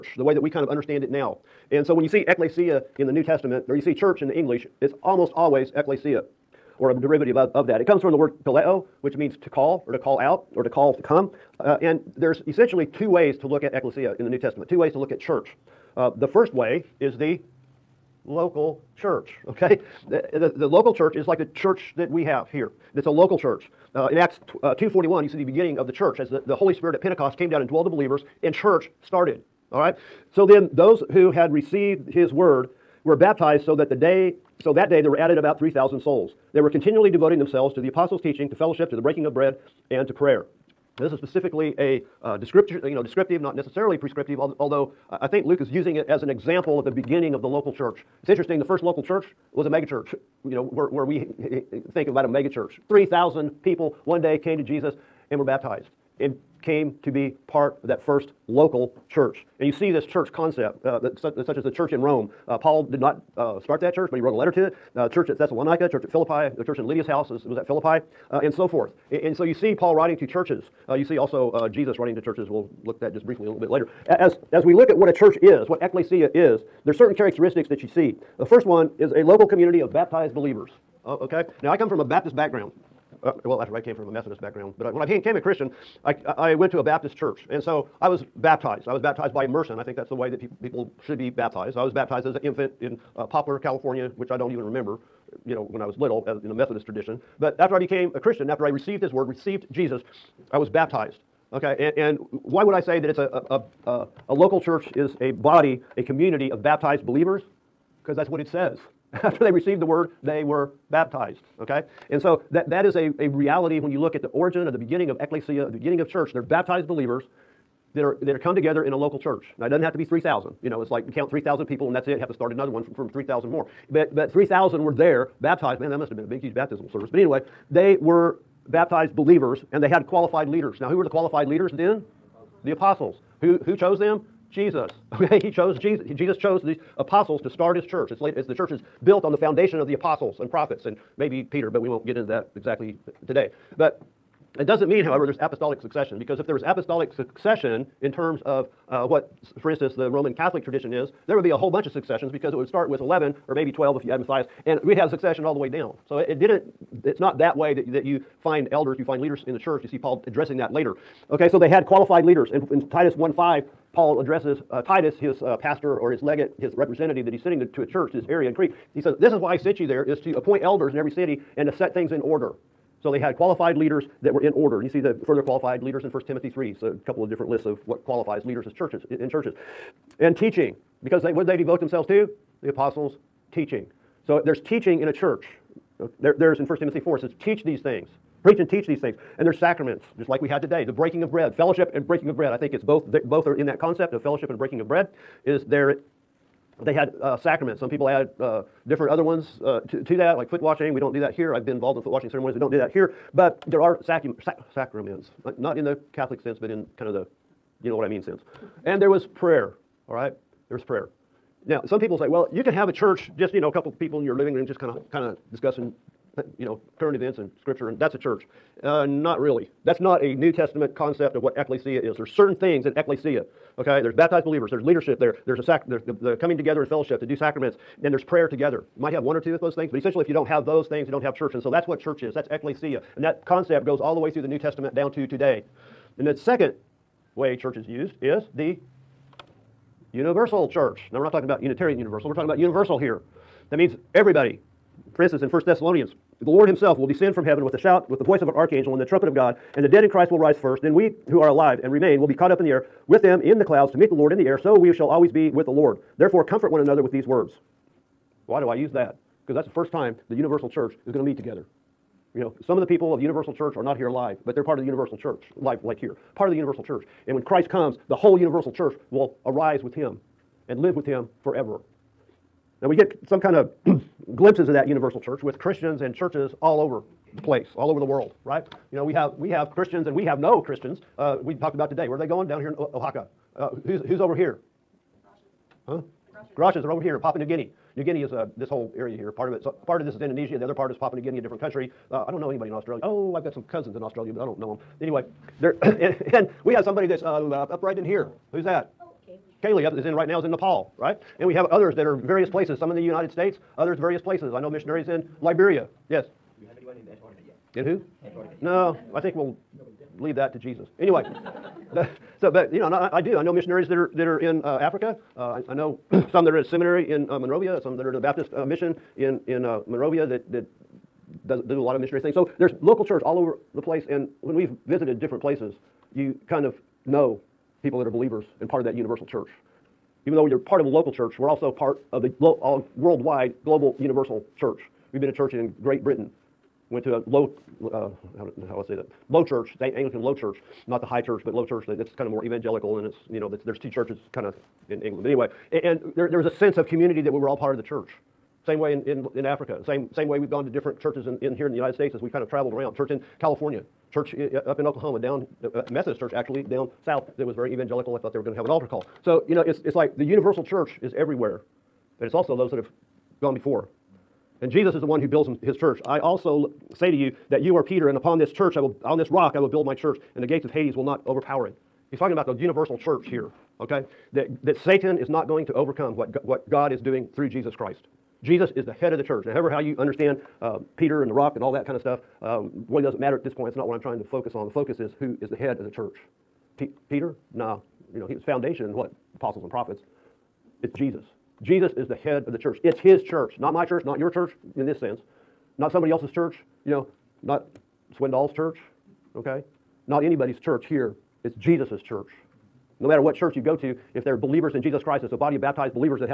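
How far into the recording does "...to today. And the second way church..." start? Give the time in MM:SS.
03:55.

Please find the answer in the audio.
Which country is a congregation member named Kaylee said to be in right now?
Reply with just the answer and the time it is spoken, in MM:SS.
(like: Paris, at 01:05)
Nepal, at 05:00.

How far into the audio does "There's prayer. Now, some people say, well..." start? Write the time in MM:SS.
03:30.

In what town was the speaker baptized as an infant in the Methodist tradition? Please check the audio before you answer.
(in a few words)
Poplar, California.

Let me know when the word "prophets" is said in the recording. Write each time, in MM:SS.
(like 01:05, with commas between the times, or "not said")
02:20, 06:29.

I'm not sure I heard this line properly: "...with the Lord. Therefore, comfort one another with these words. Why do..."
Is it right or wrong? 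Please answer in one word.
right.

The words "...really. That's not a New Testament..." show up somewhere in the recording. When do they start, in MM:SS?
03:39.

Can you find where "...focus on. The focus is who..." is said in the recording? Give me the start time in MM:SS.
06:24.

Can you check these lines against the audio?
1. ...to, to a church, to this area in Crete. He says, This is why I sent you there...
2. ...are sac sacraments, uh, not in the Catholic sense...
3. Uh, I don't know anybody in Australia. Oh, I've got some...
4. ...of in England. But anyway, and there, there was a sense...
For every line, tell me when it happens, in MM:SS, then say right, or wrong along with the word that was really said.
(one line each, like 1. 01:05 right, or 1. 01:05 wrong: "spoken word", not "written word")
1. 02:47 right
2. 03:23 right
3. 04:52 right
4. 05:44 right.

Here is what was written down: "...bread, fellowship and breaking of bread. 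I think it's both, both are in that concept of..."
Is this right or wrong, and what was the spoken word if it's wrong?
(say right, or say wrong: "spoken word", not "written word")
right.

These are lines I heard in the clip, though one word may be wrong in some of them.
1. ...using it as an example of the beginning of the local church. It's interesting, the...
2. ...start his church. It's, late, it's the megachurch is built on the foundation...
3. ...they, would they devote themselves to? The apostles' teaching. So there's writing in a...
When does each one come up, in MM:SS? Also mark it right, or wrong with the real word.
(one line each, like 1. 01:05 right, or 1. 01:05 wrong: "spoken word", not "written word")
1. 00:45 right
2. 02:17 wrong: "church", not "megachurch"
3. 03:01 wrong: "teaching", not "writing".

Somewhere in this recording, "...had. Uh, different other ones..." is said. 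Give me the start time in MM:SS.
03:18.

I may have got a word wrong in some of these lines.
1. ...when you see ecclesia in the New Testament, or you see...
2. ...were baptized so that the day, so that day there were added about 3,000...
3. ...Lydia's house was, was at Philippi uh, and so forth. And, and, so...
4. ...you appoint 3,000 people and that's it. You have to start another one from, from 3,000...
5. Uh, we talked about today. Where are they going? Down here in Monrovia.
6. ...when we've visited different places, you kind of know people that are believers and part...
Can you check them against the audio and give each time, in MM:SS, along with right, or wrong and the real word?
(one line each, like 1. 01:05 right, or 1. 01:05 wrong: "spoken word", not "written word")
1. 00:01 right
2. 00:33 right
3. 01:06 right
4. 02:01 wrong: "count", not "appoint"
5. 04:41 wrong: "Oaxaca", not "Monrovia"
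6. 05:24 right.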